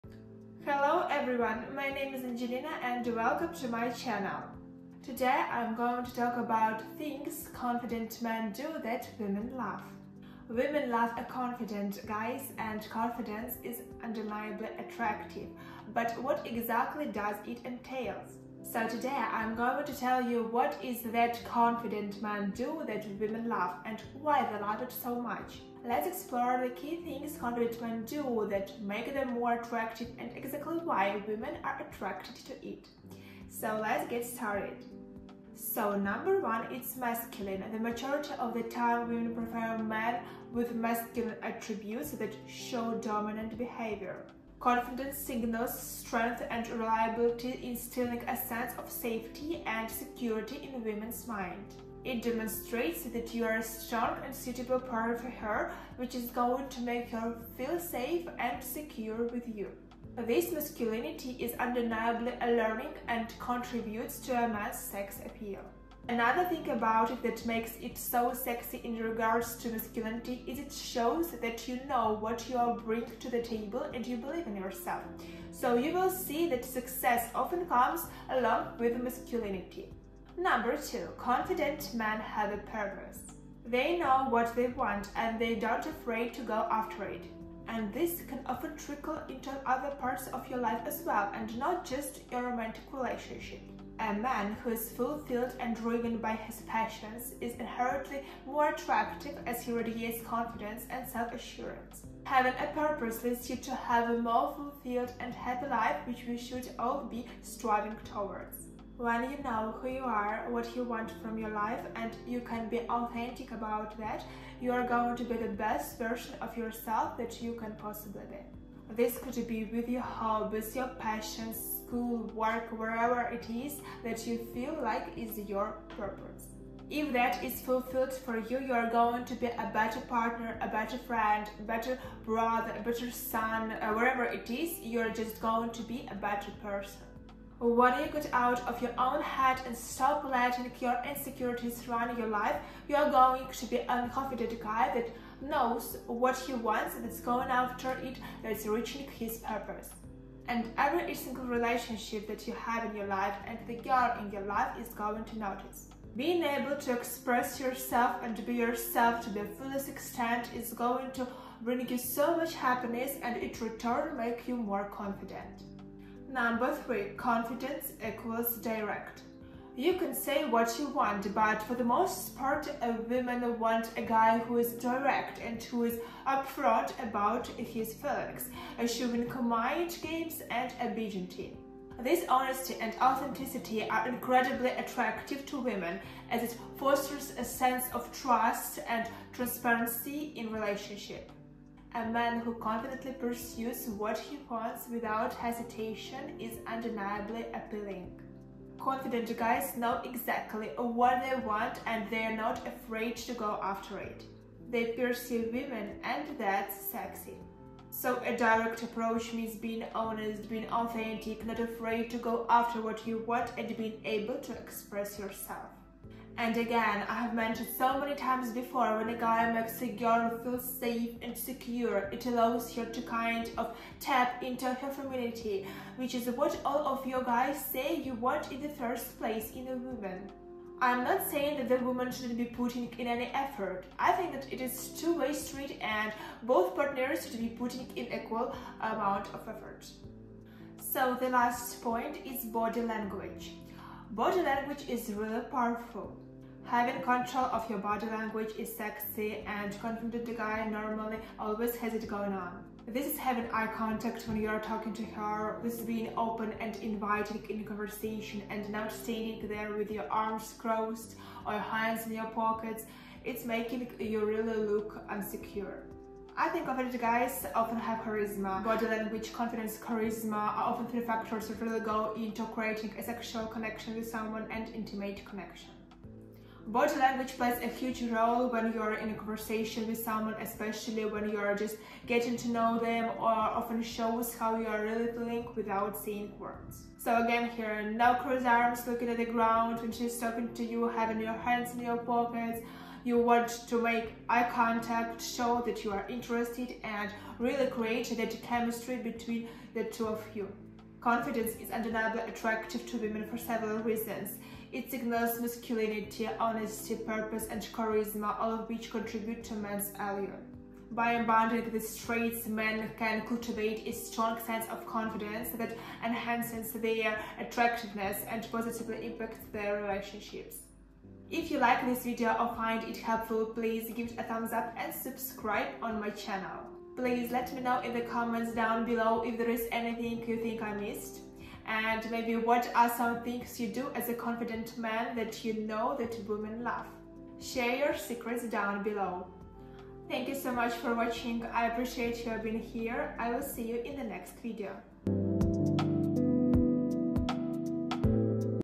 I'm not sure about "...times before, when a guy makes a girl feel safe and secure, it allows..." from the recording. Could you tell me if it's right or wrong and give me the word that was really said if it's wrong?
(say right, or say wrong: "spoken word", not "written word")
right.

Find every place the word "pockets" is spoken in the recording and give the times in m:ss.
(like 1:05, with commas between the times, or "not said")
4:22, 4:51.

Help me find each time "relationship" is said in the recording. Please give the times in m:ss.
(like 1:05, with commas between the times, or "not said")
1:32, 2:31, 3:10, 5:19.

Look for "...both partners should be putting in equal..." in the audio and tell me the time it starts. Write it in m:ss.
3:56.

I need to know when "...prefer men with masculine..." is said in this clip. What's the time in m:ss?
0:39.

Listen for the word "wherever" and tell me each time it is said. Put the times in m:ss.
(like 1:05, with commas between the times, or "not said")
2:02, 2:13.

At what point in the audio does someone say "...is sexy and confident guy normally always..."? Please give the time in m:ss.
4:08.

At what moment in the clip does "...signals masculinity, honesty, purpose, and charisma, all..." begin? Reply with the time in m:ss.
5:04.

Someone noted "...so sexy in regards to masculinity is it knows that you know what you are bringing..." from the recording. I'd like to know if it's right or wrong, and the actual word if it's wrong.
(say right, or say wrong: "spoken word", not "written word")
wrong: "shows", not "knows".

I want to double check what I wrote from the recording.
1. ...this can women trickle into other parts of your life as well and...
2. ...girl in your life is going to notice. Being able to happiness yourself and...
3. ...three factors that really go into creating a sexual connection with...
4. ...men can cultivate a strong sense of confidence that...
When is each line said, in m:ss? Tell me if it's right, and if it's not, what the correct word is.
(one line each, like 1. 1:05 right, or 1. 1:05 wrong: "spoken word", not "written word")
1. 1:27 wrong: "often", not "women"
2. 2:33 wrong: "express", not "happiness"
3. 4:30 right
4. 5:12 right.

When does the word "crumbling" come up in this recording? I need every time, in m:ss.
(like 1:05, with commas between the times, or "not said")
not said.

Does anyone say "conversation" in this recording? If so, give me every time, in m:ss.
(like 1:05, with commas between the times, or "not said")
4:17, 4:39.